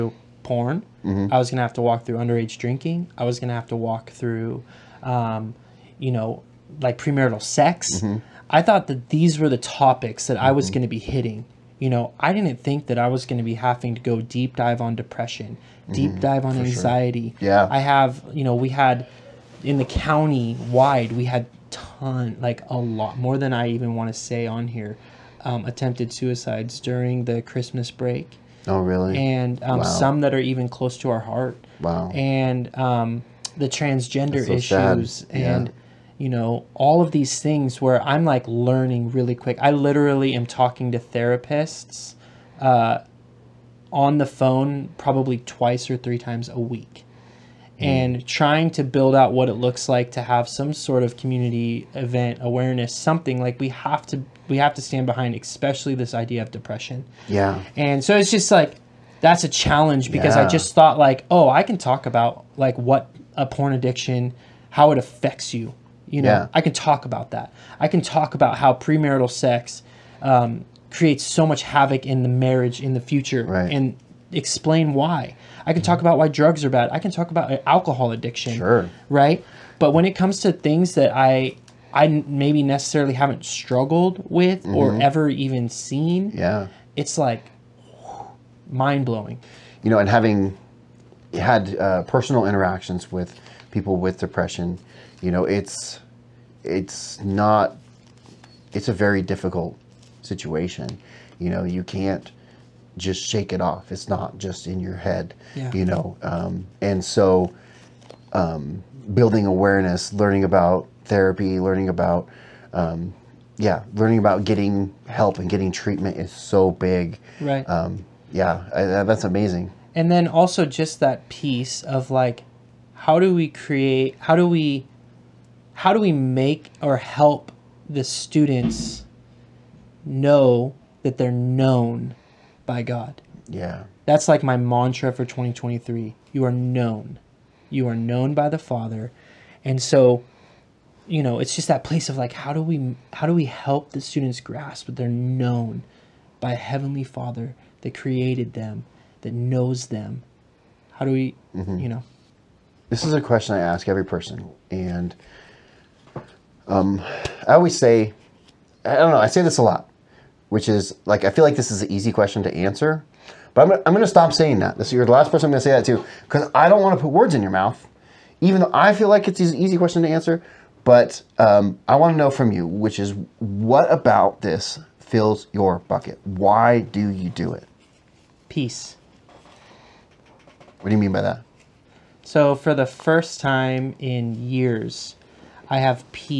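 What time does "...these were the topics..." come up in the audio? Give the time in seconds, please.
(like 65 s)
9 s.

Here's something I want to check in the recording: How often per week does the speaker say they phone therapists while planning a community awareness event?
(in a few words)
Twice or three times.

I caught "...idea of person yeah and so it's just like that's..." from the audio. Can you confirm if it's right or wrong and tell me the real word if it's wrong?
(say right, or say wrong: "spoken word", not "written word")
wrong: "depression", not "person".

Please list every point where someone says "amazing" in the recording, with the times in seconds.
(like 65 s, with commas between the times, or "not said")
119 s.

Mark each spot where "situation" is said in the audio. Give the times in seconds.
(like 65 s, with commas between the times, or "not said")
100 s.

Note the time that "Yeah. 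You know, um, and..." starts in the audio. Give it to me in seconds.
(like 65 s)
105 s.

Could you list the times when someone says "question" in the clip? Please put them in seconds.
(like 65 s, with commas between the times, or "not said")
153 s, 162 s, 169 s.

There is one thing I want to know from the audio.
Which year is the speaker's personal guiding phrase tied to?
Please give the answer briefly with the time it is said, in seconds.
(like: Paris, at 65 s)
2023, at 135 s.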